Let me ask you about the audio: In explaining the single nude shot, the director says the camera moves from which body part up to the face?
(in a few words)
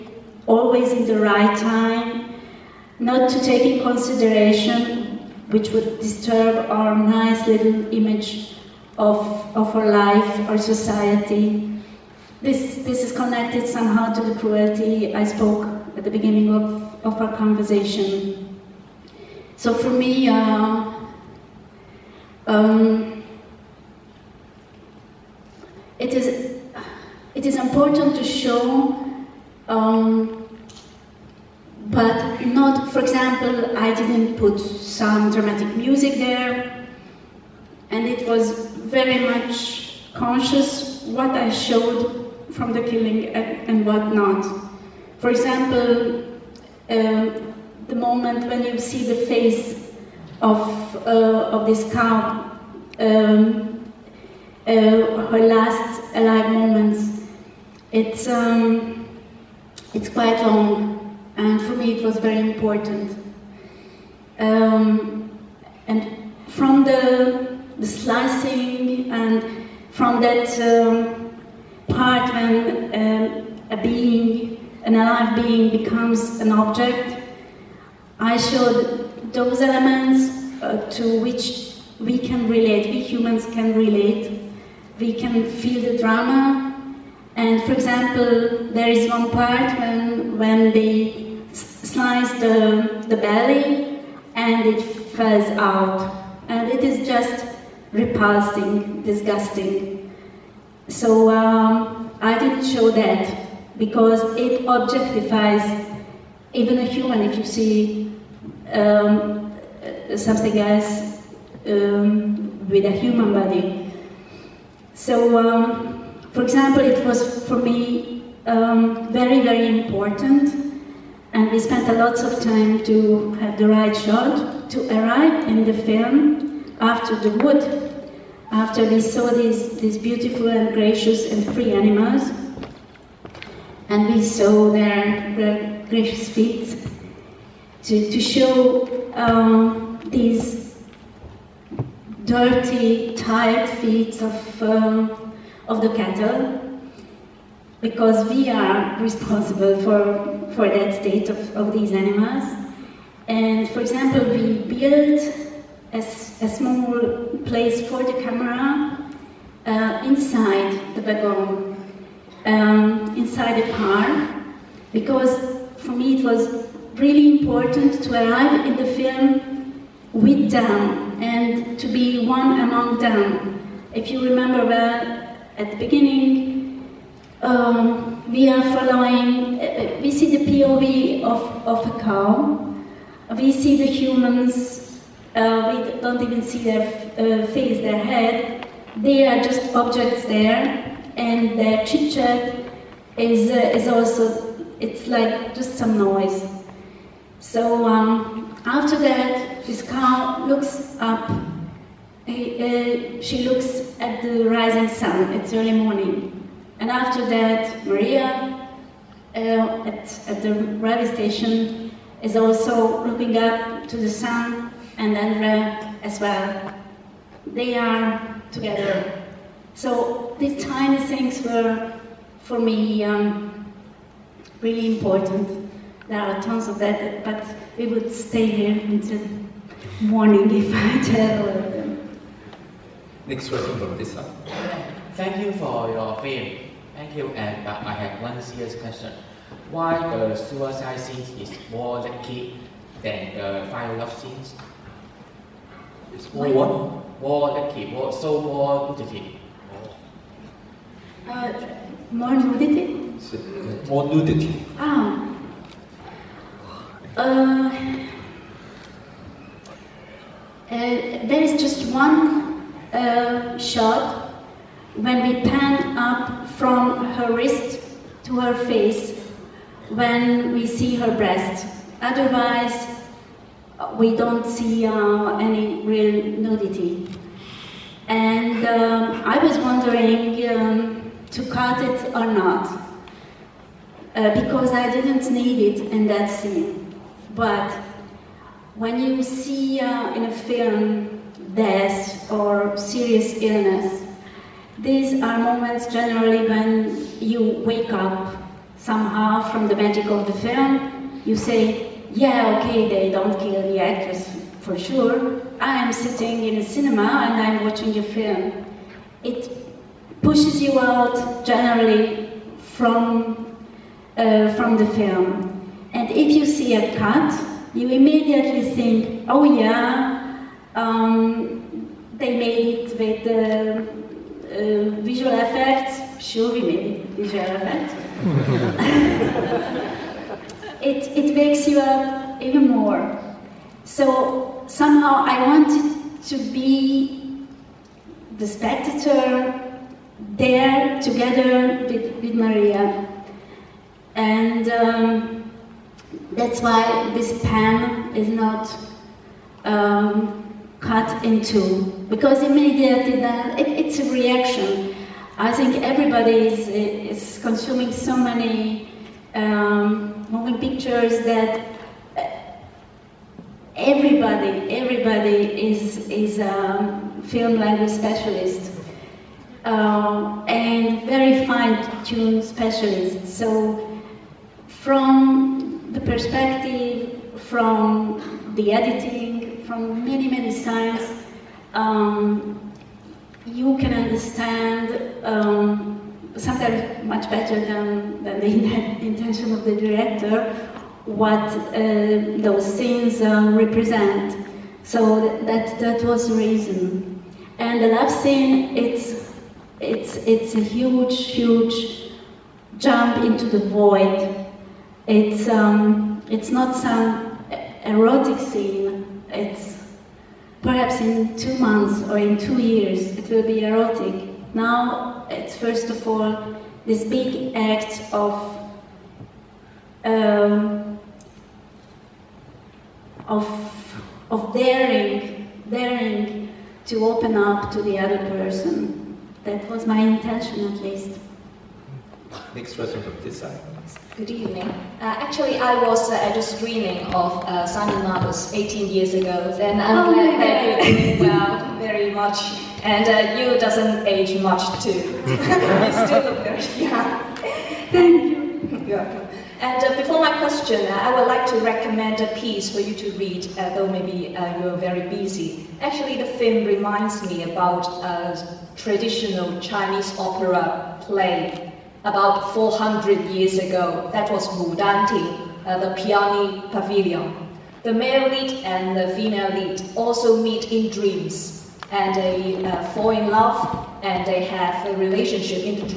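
her wrist.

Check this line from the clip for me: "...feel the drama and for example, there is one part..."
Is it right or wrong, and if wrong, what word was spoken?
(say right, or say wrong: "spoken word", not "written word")
right.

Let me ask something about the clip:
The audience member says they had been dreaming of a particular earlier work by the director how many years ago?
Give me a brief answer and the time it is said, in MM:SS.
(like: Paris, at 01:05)
18, at 07:18.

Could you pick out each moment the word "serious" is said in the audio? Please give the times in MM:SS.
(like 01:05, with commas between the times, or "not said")
03:58, 04:52.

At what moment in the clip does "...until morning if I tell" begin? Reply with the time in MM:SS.
03:48.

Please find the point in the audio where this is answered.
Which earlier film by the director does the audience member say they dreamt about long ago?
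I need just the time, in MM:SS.
07:17.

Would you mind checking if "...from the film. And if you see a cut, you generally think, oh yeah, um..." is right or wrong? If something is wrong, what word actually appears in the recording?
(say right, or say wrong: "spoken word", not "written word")
wrong: "immediately", not "generally".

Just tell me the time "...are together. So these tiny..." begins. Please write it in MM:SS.
03:37.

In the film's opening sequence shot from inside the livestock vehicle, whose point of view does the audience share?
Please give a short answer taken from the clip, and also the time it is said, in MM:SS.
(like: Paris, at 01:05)
a cow, at 03:01.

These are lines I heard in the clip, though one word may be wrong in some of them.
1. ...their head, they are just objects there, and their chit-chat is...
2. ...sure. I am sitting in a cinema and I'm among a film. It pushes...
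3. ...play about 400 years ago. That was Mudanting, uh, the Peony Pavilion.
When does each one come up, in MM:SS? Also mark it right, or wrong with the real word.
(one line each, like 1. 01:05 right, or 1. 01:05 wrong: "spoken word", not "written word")
1. 03:07 right
2. 05:04 wrong: "watching", not "among"
3. 07:41 right.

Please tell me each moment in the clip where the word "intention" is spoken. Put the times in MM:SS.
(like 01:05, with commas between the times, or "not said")
06:29, 07:09.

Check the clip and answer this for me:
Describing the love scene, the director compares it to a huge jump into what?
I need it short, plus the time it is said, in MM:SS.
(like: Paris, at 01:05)
the void, at 06:43.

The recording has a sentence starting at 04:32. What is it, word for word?
Otherwise, we don't see uh, any real nudity.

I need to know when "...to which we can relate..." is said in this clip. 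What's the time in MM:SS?
01:20.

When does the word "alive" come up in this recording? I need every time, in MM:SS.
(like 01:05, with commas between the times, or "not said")
00:56, 01:14.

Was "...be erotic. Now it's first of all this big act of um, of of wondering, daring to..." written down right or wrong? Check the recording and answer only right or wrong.
wrong.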